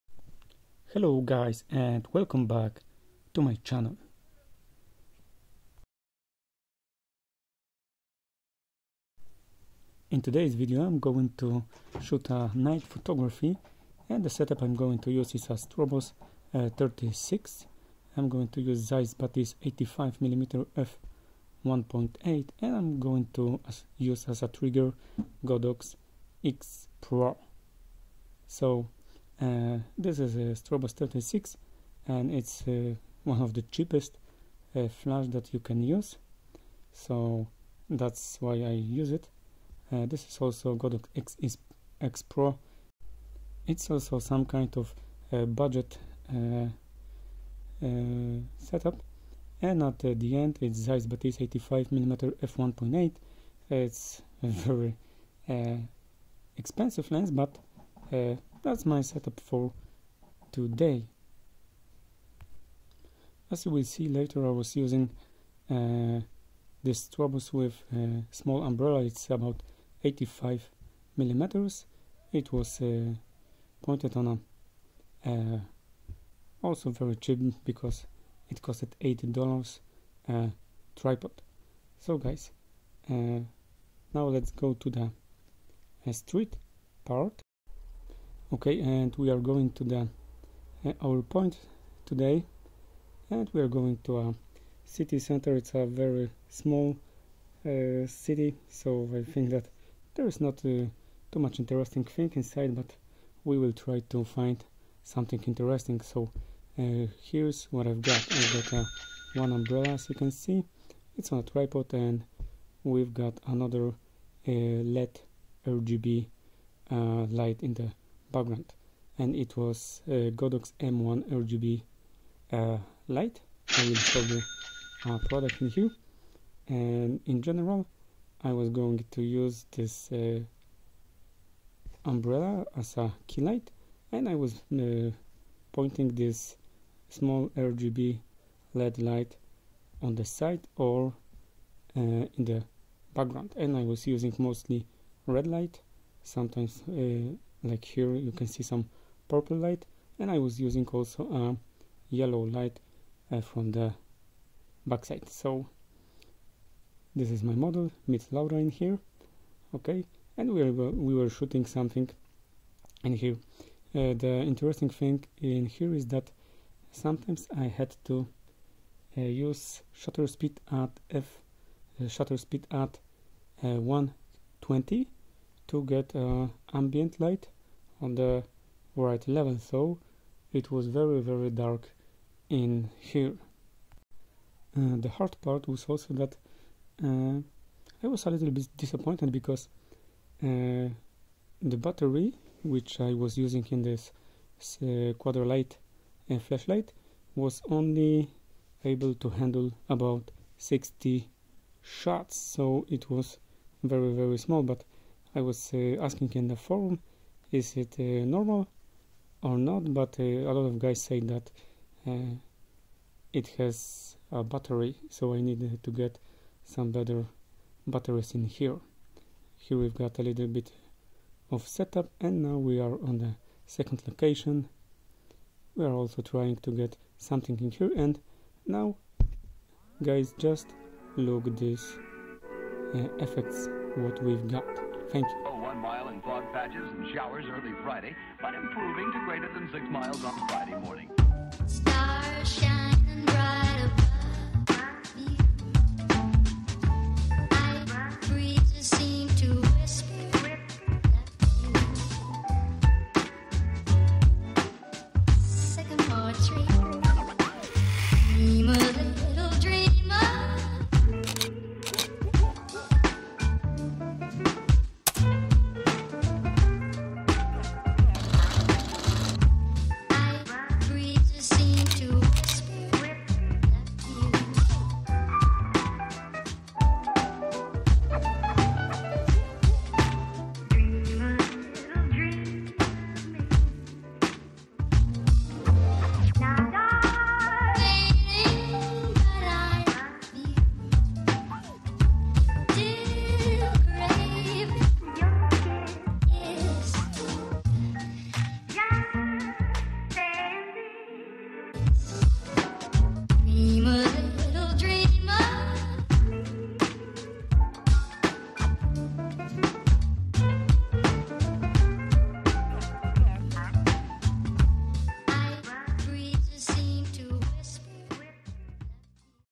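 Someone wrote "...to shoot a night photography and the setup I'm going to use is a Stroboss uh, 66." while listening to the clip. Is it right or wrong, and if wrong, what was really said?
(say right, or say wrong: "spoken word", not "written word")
wrong: "36", not "66".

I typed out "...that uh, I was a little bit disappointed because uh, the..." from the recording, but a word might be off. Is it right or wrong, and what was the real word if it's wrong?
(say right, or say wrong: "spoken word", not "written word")
right.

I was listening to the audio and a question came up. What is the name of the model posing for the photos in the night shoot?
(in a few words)
Laura.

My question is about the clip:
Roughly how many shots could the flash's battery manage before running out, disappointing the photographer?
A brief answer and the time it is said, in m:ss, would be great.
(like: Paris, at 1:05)
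60, at 3:20.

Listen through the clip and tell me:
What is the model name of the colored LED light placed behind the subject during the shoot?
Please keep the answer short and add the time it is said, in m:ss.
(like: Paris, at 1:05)
Godox M1 RGB, at 2:00.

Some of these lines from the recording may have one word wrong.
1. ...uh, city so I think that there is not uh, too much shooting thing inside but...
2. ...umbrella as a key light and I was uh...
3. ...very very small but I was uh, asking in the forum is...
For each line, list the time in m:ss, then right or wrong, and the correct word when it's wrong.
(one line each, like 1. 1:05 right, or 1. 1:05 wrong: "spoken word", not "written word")
1. 1:37 wrong: "interesting", not "shooting"
2. 2:12 right
3. 3:23 right.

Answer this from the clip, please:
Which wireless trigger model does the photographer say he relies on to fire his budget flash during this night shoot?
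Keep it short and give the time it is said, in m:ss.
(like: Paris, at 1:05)
Godox X Pro, at 0:25.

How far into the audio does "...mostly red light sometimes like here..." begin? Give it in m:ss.
2:24.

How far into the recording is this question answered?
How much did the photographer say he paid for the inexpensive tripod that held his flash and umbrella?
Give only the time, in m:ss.
1:19.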